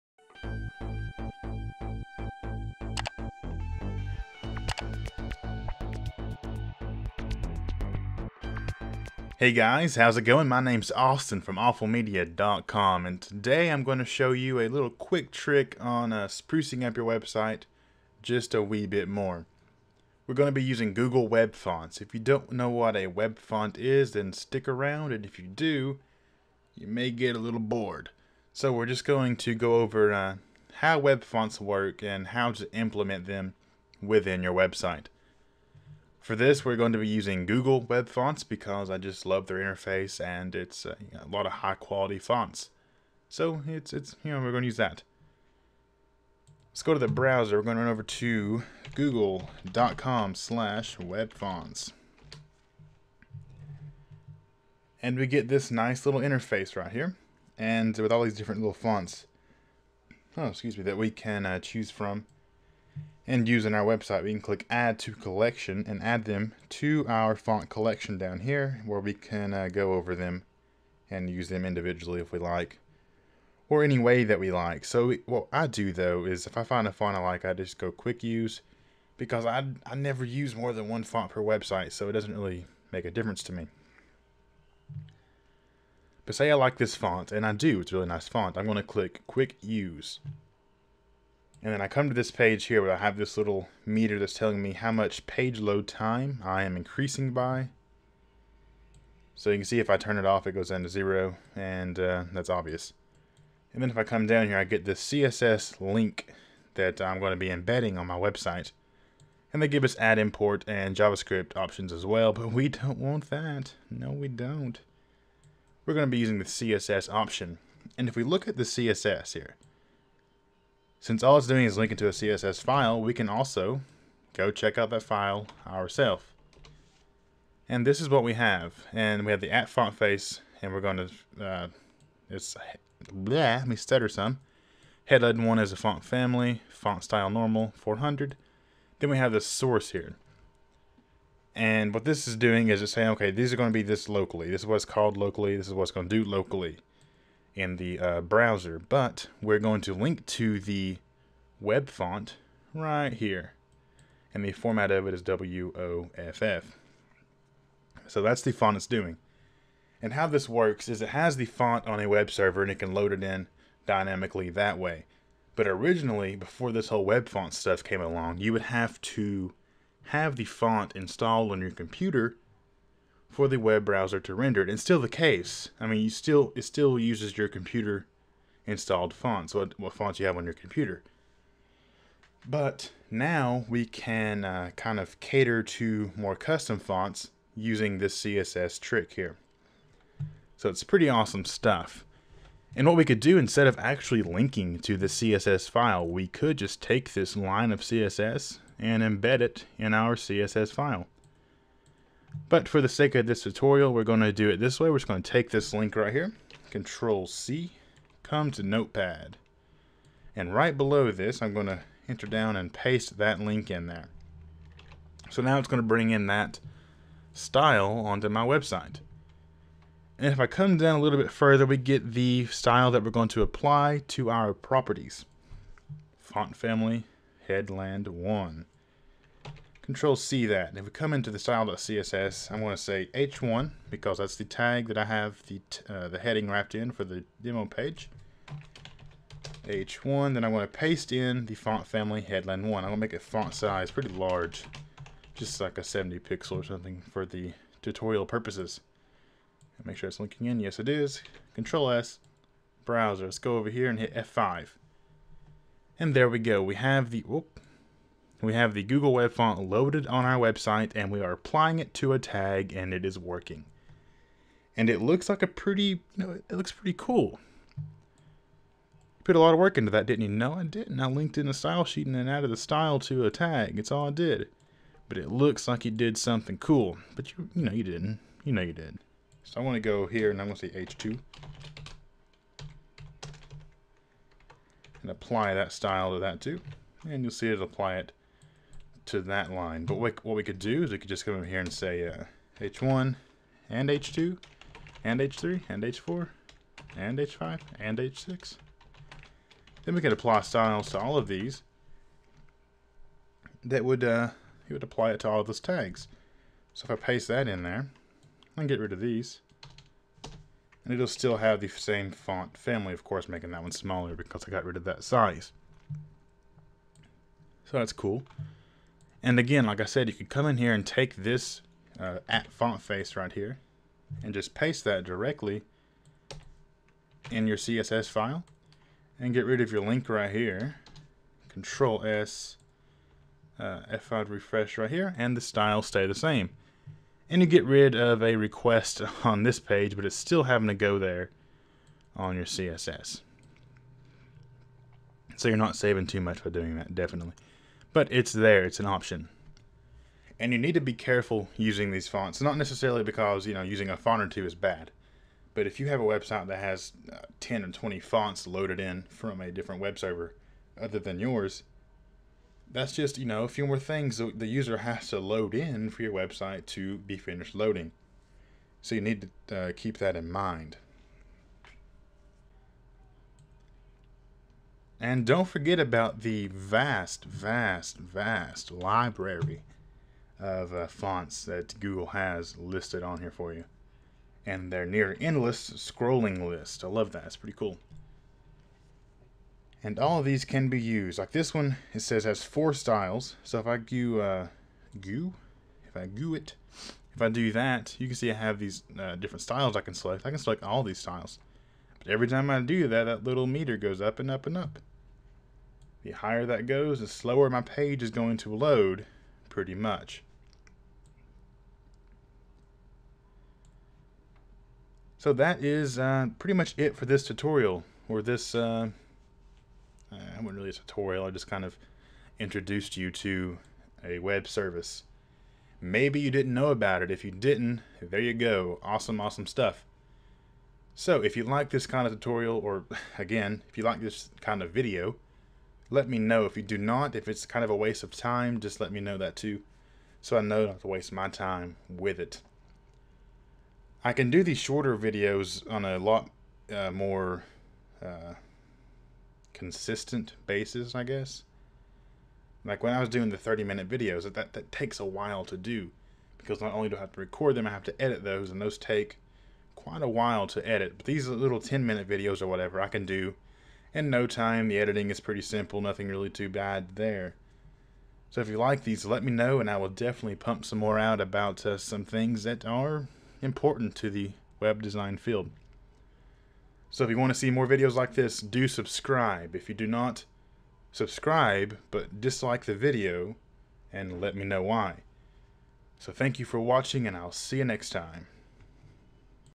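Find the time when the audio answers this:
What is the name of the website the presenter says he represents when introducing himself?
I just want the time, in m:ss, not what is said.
0:11.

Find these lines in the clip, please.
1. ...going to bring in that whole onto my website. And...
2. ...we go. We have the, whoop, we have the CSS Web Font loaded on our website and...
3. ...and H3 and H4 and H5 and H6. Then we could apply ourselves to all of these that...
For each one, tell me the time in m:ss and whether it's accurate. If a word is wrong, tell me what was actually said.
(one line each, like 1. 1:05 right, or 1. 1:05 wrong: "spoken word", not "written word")
1. 3:35 wrong: "style", not "whole"
2. 4:16 wrong: "Google", not "CSS"
3. 4:55 wrong: "styles", not "ourselves".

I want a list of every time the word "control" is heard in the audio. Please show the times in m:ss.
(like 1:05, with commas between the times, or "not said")
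3:26, 3:49, 4:11, 5:31.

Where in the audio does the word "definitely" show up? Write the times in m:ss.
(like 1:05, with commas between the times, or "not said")
5:46, 7:49.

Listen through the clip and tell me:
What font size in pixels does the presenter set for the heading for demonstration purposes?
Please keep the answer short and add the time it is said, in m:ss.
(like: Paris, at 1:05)
70 pixels, at 4:05.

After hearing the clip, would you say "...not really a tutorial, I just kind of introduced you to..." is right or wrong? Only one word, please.
right.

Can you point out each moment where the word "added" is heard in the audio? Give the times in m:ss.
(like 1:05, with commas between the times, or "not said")
4:32.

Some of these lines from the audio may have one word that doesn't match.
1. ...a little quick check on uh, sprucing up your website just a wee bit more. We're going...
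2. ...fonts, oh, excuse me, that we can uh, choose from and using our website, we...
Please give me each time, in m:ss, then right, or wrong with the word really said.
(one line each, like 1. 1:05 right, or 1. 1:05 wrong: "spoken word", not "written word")
1. 0:14 wrong: "trick", not "check"
2. 0:58 right.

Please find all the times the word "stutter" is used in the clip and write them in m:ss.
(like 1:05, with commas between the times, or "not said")
2:13.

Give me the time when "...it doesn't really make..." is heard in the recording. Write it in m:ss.
1:22.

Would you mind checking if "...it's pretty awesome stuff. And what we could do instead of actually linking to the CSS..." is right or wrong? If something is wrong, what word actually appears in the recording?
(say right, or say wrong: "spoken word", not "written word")
right.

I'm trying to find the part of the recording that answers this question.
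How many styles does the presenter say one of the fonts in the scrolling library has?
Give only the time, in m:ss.
6:32.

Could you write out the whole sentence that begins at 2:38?
So that's the font it's doing.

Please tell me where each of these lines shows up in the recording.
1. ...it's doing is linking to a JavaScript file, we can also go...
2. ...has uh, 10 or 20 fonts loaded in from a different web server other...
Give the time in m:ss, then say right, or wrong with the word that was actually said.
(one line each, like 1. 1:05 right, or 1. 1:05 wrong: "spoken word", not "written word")
1. 2:01 wrong: "CSS", not "JavaScript"
2. 5:56 right.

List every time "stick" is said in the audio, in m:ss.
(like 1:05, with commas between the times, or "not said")
0:24.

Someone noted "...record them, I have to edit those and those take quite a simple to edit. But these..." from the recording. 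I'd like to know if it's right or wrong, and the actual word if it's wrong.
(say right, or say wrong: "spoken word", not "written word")
wrong: "while", not "simple".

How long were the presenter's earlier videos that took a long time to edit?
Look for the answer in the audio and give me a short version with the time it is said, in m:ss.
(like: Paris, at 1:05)
30 minutes, at 7:33.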